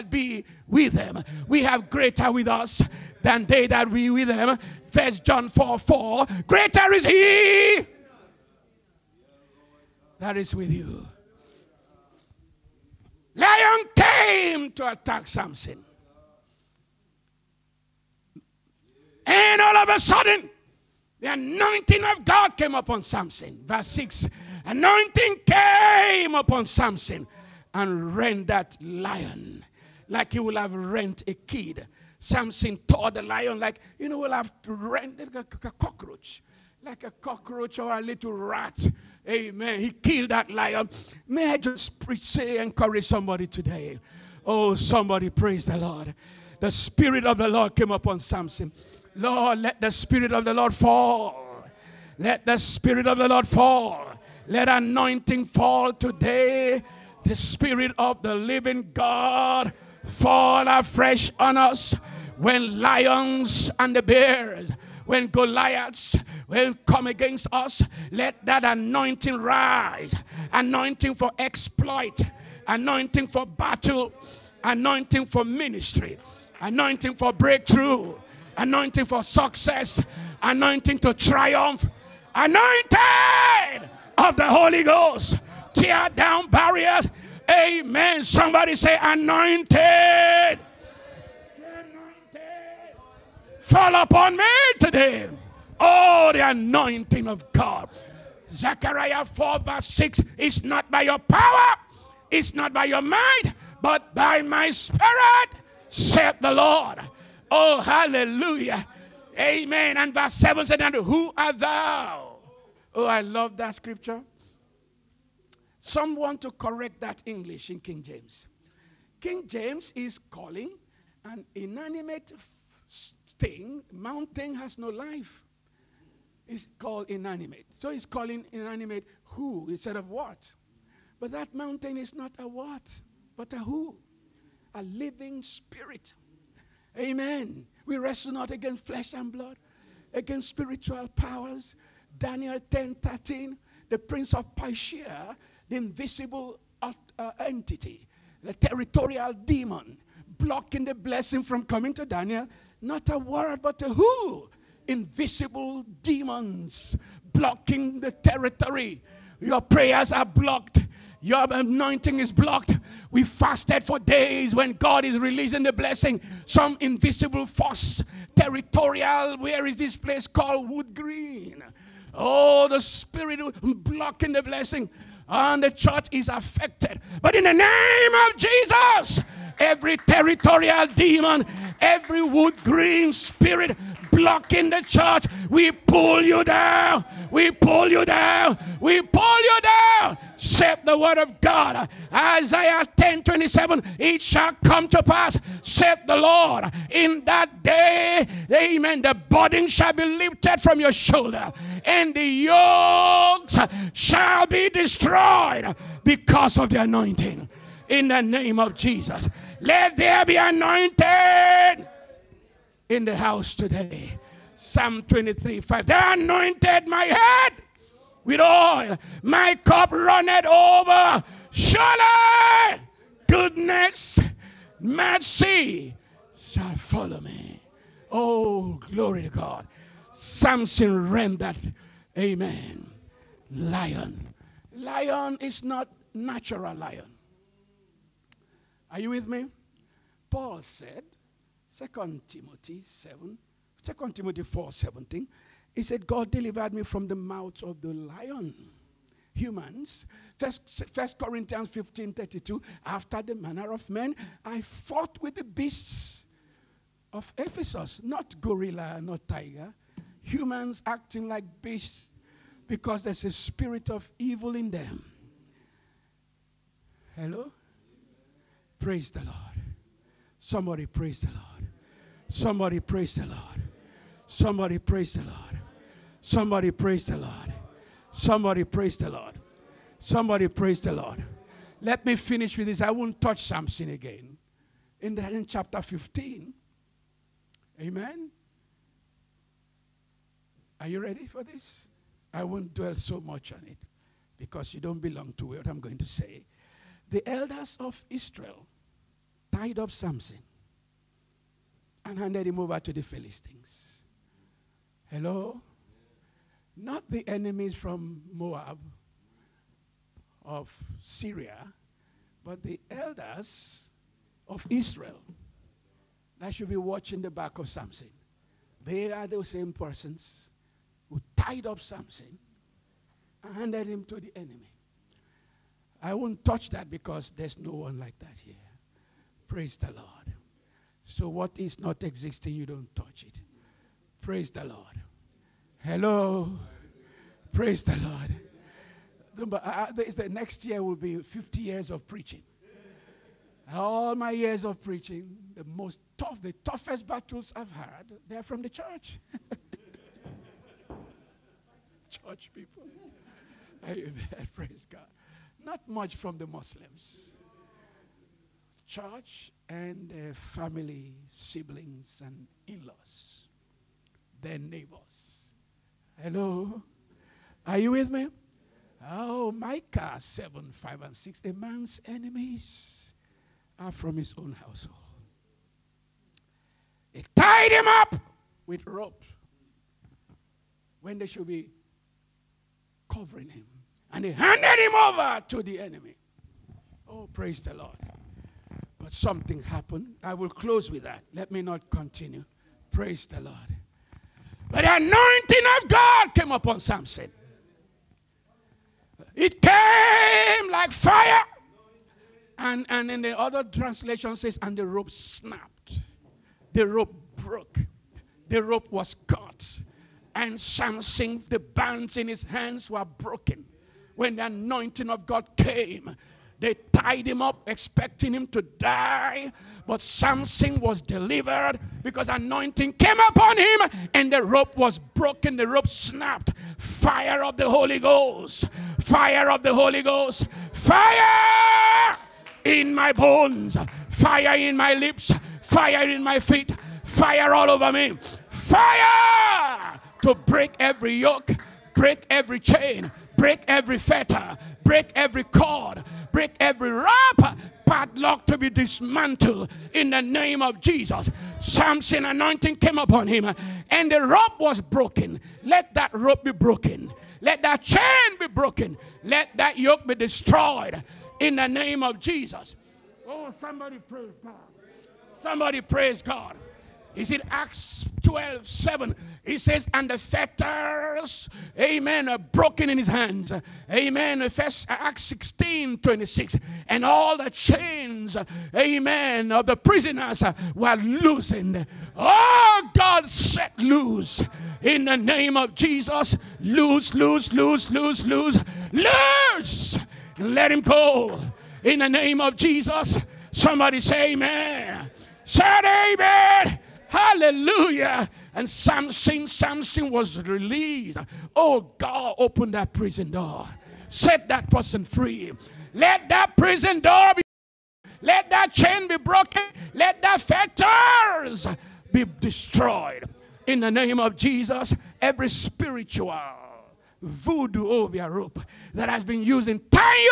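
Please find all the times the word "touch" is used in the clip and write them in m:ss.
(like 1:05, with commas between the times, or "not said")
4:43, 5:26, 5:32.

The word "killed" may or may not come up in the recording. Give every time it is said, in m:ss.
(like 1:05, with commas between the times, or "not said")
0:39.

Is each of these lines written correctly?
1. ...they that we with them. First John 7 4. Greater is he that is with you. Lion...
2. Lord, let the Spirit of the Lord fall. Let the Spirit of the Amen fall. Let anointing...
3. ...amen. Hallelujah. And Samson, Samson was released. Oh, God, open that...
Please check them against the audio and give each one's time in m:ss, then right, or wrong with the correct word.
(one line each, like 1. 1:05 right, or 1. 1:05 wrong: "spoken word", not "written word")
1. 0:03 wrong: "4", not "7"
2. 0:49 wrong: "Lord", not "Amen"
3. 8:16 right.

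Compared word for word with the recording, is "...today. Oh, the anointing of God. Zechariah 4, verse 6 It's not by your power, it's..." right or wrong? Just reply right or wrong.
right.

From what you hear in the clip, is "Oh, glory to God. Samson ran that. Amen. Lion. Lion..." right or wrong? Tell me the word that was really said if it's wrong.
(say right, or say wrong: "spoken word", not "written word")
right.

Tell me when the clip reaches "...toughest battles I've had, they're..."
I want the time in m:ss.
5:46.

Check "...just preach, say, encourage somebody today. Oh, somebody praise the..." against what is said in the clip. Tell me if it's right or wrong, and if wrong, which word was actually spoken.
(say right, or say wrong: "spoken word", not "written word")
right.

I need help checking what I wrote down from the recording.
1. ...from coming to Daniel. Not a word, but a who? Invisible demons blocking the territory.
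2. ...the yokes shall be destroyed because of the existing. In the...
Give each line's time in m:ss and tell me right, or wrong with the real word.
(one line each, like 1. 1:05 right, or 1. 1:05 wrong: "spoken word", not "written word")
1. 2:31 right
2. 3:22 wrong: "anointing", not "existing".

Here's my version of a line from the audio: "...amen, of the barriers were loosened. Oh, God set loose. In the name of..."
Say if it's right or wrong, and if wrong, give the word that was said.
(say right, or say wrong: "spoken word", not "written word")
wrong: "prisoners", not "barriers".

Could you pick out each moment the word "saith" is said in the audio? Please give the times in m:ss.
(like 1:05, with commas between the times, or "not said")
1:45, 3:10, 3:15.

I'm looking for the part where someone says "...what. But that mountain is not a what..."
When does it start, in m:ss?
2:10.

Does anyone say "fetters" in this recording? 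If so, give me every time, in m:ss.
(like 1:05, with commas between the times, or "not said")
7:23, 7:50, 8:30.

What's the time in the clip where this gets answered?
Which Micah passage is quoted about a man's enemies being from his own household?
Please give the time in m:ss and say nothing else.
6:09.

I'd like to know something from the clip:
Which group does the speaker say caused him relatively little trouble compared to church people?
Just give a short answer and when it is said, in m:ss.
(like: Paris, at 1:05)
Muslims, at 5:56.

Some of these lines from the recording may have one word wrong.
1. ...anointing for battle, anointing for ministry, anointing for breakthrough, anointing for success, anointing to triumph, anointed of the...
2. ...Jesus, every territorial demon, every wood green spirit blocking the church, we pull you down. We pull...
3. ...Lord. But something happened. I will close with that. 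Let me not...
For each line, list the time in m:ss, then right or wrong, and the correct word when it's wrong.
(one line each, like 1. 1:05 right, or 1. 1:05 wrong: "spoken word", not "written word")
1. 1:12 right
2. 2:58 right
3. 6:27 right.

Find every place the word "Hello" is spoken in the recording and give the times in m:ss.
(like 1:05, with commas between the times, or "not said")
4:27, 5:05, 5:35, 6:06.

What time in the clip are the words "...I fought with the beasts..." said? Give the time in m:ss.
4:14.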